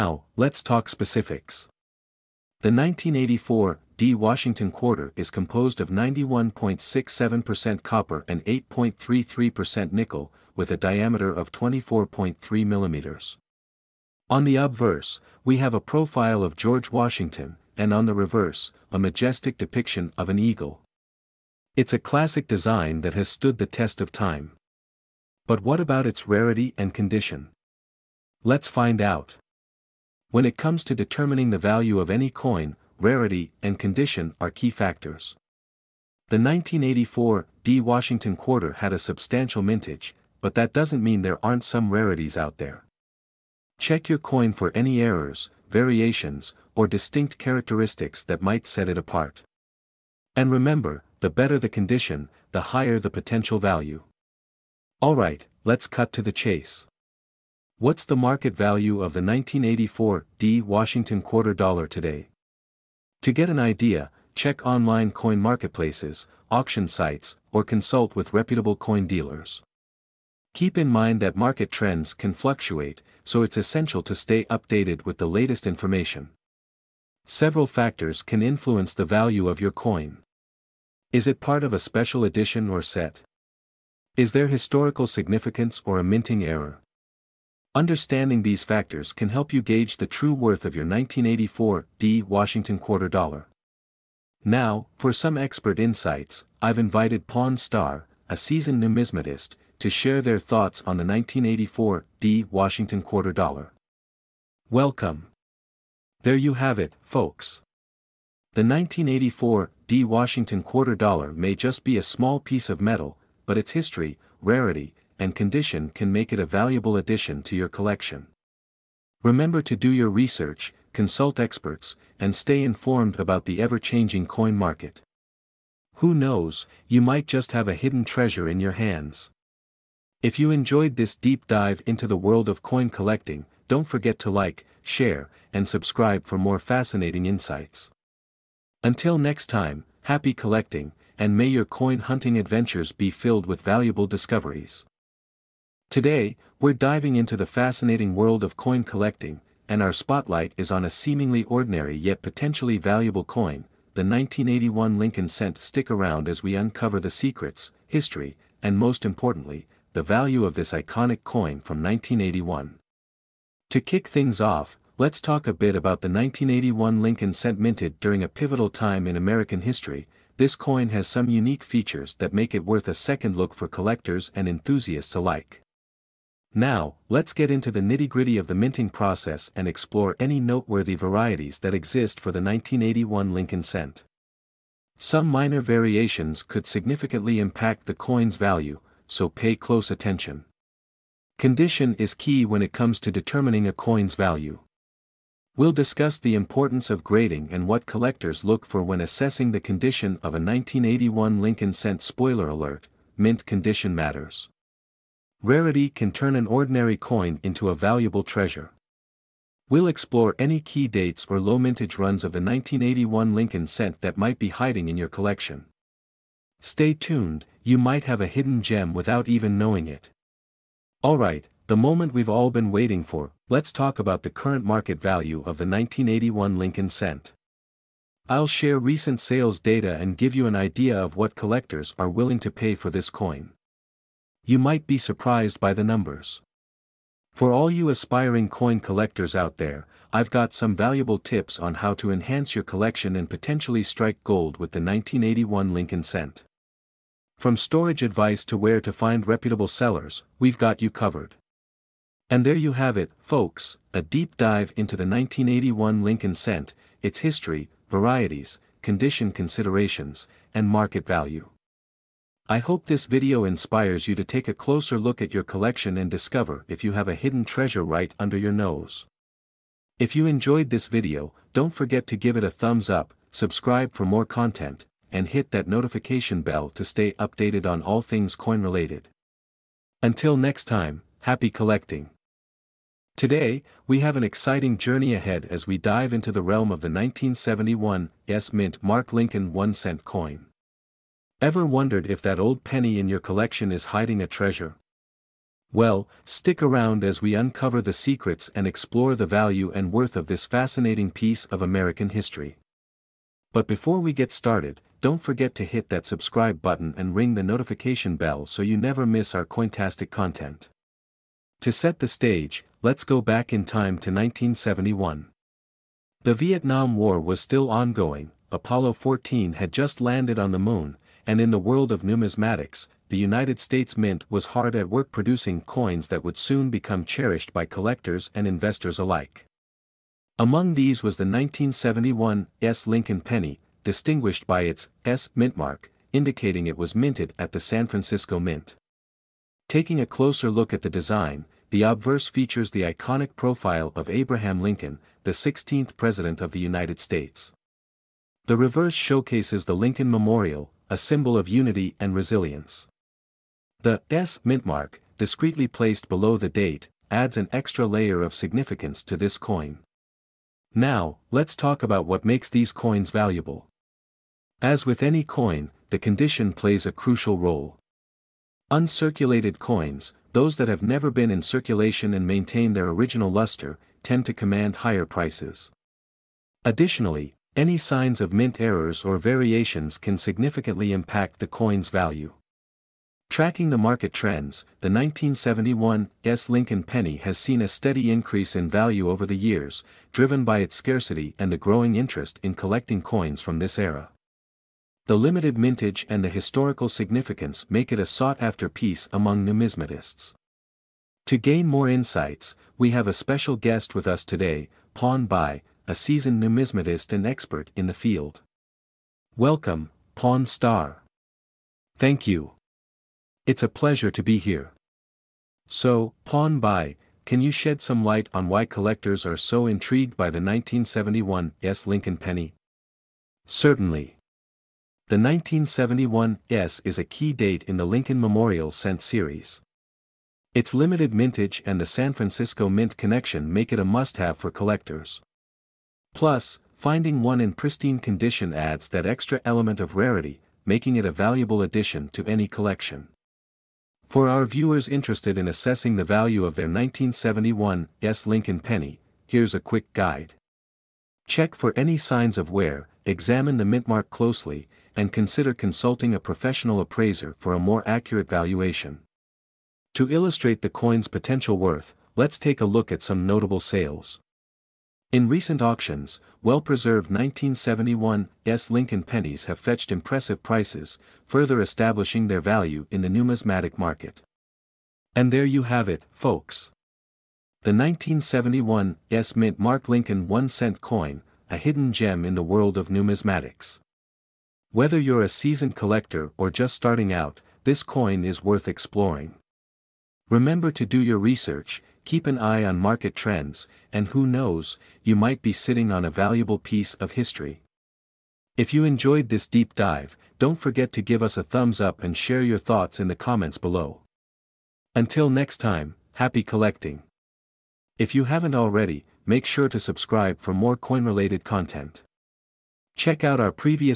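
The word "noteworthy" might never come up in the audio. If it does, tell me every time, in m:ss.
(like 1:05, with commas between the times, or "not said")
3:00.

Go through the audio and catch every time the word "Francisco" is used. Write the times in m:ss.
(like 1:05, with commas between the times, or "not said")
5:37, 7:12.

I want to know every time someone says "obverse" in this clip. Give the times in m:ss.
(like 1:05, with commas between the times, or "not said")
0:14, 5:41.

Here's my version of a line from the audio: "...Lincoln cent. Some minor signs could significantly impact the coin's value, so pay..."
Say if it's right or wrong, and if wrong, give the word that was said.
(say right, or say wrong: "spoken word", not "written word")
wrong: "variations", not "signs".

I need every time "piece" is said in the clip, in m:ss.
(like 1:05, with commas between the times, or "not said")
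1:52, 5:01, 6:38, 8:16.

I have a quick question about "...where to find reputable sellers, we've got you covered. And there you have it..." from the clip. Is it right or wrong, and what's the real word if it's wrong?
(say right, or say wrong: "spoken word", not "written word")
right.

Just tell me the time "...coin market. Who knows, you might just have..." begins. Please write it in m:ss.
2:04.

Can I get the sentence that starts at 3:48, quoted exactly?
I'll share recent sales data and give you an idea of what collectors are willing to pay for this coin.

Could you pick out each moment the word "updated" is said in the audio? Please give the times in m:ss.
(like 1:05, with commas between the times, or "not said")
1:14, 4:37.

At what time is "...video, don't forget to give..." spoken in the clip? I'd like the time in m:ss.
4:30.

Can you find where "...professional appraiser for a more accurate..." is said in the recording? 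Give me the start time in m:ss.
7:36.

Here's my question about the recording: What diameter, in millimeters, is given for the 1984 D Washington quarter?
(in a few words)
24.3 mm.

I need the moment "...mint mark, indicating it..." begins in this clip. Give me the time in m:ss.
5:35.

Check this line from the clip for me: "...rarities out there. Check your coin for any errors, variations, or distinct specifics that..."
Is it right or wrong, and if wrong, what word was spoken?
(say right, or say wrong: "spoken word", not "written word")
wrong: "characteristics", not "specifics".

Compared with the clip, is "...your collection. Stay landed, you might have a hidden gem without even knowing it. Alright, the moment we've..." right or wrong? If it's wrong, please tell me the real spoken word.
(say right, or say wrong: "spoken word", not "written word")
wrong: "tuned", not "landed".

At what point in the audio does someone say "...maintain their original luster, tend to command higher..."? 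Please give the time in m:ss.
6:12.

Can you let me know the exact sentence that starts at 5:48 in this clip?
The reverse showcases the Lincoln Memorial, a symbol of unity and resilience.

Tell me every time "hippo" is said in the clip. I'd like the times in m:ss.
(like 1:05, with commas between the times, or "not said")
not said.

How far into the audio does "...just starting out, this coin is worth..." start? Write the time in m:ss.
8:06.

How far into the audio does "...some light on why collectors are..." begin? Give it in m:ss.
6:57.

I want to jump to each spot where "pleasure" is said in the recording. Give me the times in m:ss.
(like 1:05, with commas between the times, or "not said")
6:53.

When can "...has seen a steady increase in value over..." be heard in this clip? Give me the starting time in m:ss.
6:27.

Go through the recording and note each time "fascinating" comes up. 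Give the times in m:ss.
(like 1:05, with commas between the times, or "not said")
2:16, 2:27, 5:00.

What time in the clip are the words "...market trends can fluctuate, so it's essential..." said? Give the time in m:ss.
1:11.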